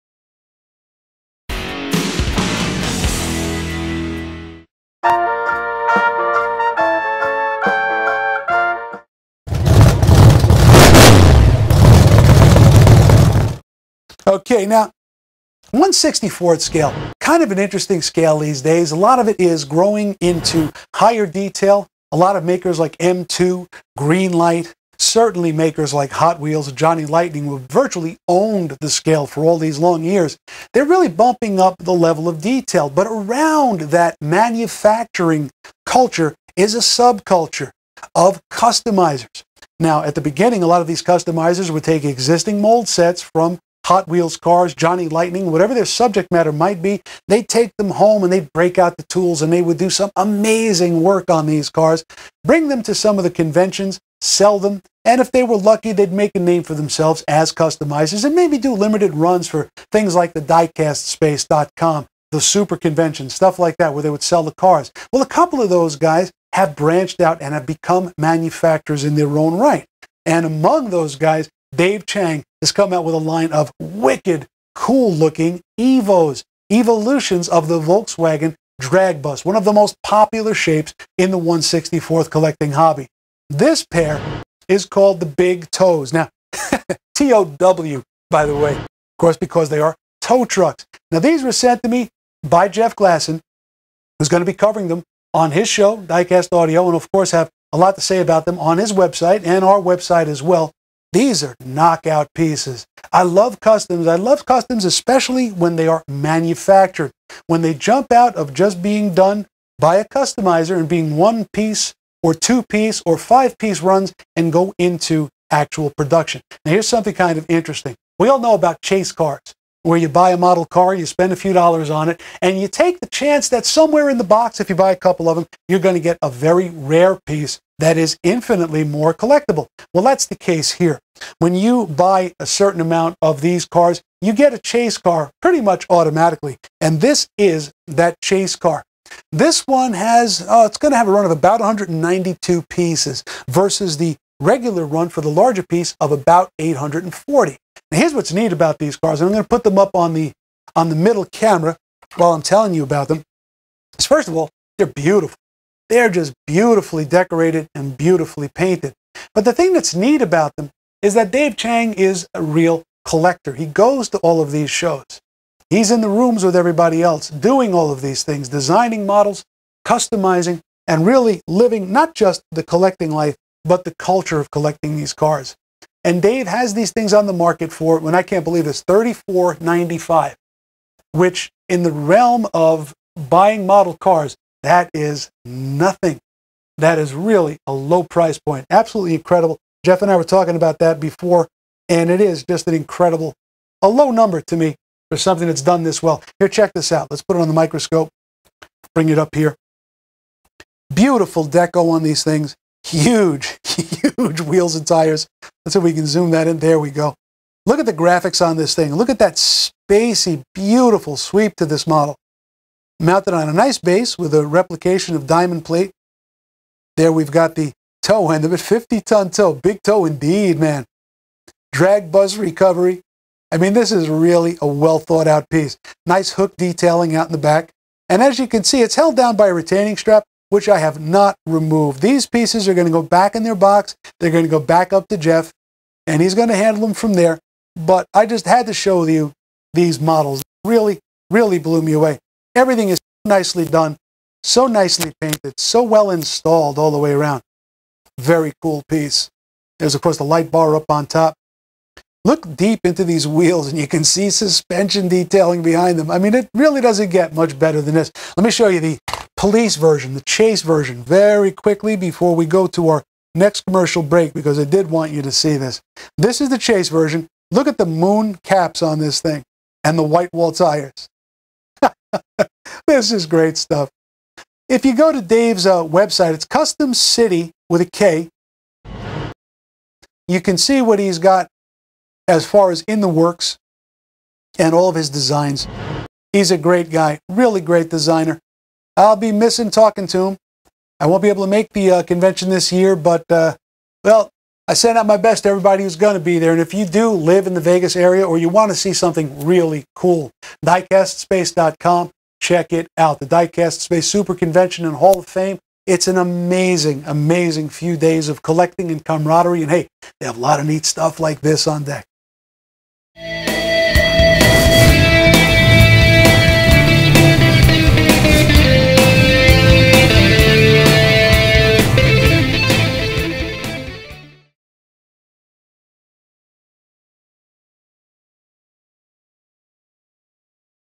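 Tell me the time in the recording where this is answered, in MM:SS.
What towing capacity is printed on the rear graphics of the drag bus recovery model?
03:38.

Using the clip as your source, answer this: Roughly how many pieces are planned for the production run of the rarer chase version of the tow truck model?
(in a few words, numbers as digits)
192.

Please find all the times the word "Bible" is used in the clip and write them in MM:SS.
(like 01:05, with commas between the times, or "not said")
not said.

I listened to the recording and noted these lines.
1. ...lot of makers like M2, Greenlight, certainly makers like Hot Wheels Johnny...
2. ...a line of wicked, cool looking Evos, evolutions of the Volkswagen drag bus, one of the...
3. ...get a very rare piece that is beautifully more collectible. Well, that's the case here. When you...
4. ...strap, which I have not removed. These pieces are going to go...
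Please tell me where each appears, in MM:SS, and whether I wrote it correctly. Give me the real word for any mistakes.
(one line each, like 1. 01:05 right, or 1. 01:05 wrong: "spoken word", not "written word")
1. 00:22 right
2. 01:13 right
3. 02:06 wrong: "infinitely", not "beautifully"
4. 03:49 right.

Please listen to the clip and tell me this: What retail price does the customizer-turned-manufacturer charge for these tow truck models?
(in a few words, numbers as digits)
$34.95.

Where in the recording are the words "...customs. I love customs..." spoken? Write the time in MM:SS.
01:43.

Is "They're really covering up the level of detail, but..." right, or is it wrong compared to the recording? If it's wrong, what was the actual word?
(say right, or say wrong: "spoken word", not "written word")
wrong: "bumping", not "covering".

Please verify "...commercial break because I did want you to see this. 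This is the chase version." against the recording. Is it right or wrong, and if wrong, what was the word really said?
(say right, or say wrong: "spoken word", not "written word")
right.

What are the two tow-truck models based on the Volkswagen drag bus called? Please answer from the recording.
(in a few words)
Big Tows.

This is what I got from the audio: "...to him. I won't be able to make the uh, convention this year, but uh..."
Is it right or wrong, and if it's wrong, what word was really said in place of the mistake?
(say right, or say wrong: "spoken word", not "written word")
right.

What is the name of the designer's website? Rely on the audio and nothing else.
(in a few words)
Kustom City.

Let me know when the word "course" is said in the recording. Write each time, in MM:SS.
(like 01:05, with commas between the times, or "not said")
01:29, 01:37, 04:10.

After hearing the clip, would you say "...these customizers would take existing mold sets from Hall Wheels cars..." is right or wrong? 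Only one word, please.
wrong.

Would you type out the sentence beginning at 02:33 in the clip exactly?
Is first of all, they're beautiful.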